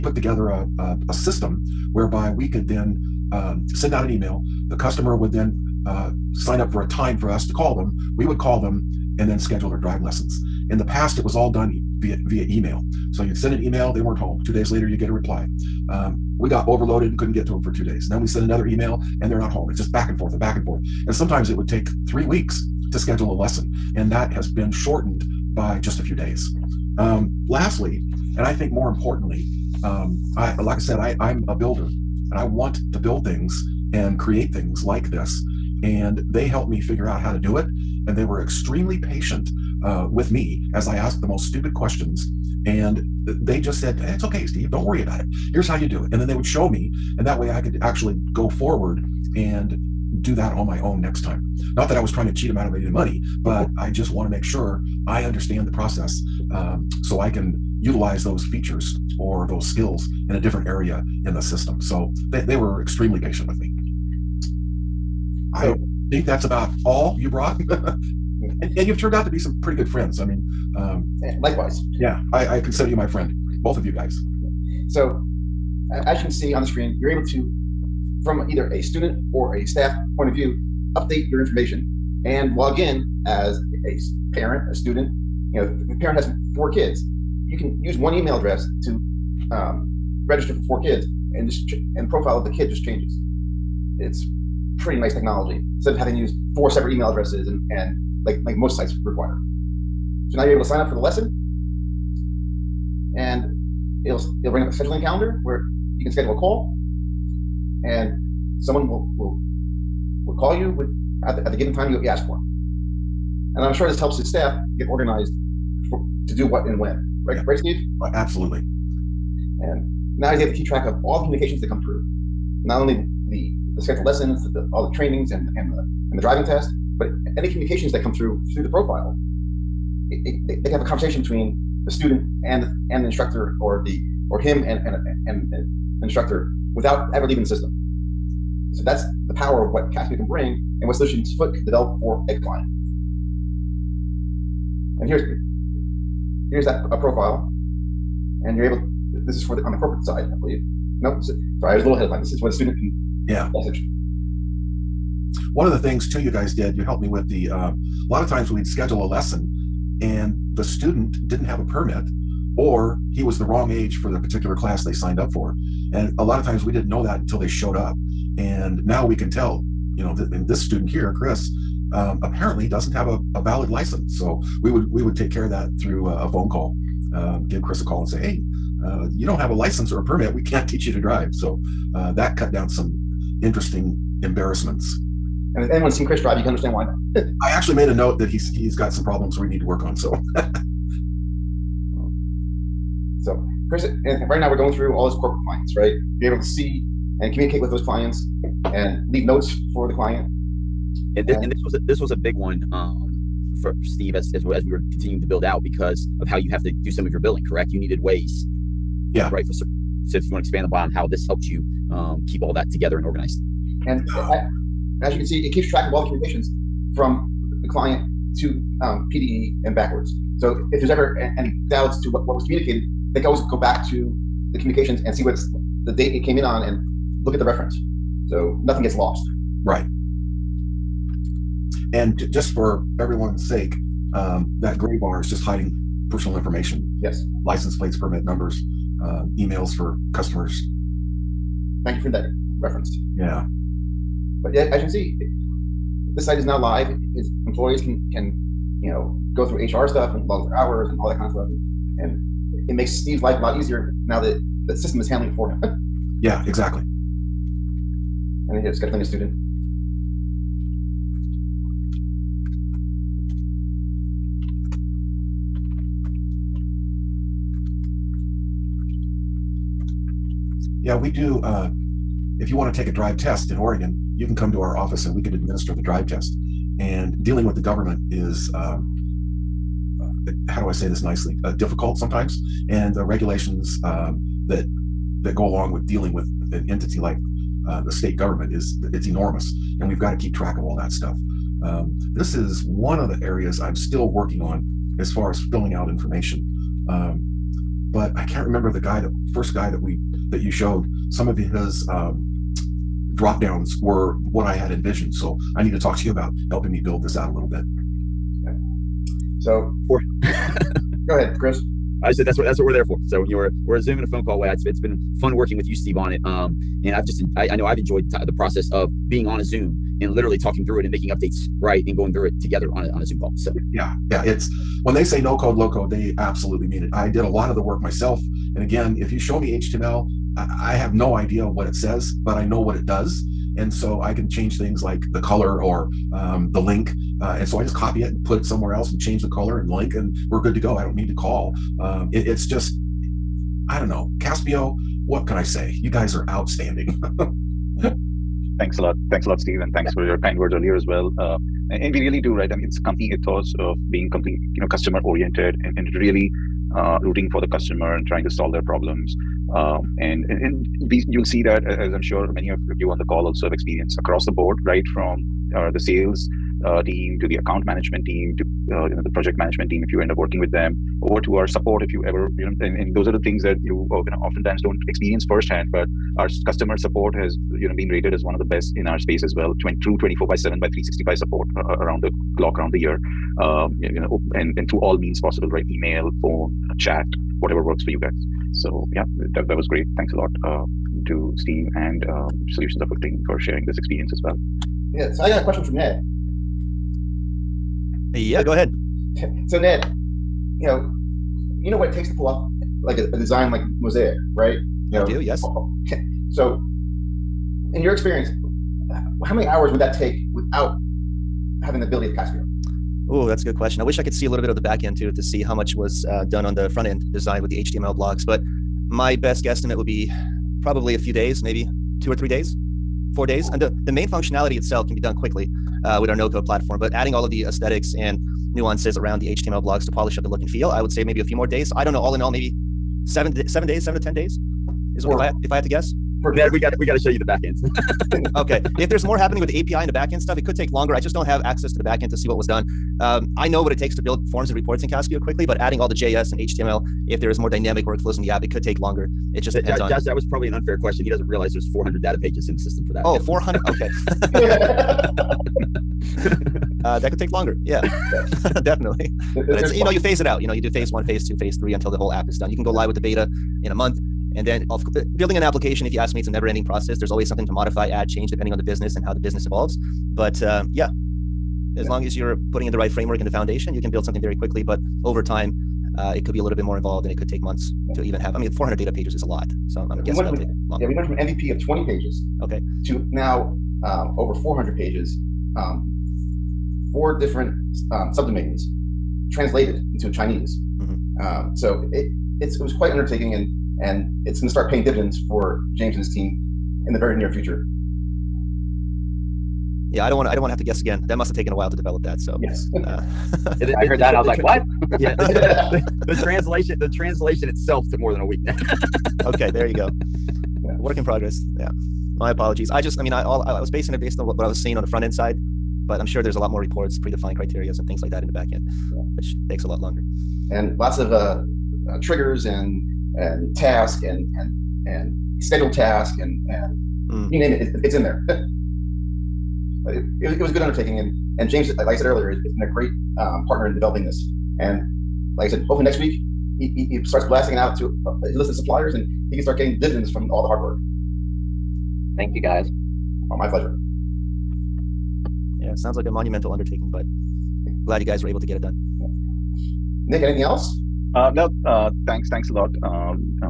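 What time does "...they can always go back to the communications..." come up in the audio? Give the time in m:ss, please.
3:43.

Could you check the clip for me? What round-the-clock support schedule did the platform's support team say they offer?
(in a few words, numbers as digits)
24 by 7.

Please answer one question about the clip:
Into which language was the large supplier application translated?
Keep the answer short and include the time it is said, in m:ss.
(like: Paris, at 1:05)
Chinese, at 8:10.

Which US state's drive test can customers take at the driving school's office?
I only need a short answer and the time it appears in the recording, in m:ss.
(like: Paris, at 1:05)
Oregon, at 4:33.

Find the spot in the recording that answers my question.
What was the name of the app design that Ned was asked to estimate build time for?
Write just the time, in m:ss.
6:43.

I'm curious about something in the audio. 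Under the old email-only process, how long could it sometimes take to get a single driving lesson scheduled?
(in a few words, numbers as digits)
3 weeks.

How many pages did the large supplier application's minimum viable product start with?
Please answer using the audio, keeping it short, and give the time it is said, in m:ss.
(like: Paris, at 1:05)
20, at 8:01.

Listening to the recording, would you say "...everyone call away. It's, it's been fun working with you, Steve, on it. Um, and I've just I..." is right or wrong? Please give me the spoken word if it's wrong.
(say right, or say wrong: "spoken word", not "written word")
wrong: "phone", not "everyone".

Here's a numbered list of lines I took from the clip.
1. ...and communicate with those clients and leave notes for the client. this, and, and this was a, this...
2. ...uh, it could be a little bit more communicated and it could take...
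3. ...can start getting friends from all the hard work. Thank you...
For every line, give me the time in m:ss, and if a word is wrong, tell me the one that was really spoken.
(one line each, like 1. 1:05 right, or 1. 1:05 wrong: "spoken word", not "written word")
1. 3:17 right
2. 7:55 wrong: "involved", not "communicated"
3. 8:59 wrong: "dividends", not "friends".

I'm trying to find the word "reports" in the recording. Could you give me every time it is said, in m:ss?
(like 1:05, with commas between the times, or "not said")
7:24, 8:36.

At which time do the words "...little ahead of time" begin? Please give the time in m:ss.
2:31.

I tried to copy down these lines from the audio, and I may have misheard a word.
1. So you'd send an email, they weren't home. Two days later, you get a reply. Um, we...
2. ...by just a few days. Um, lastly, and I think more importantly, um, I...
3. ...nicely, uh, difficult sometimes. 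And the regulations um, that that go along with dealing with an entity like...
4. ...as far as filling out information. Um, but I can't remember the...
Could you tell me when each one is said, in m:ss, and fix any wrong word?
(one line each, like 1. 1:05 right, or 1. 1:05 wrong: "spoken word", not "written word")
1. 0:13 right
2. 0:25 right
3. 4:41 right
4. 4:54 right.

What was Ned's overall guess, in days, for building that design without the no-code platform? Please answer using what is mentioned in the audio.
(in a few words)
7 to 10 days.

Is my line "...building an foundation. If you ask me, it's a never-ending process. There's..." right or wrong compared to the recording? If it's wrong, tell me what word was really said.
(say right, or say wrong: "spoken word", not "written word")
wrong: "application", not "foundation".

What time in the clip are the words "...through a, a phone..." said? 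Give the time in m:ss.
2:55.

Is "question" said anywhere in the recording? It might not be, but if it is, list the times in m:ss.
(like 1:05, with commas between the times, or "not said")
0:41, 6:35, 6:53, 7:30.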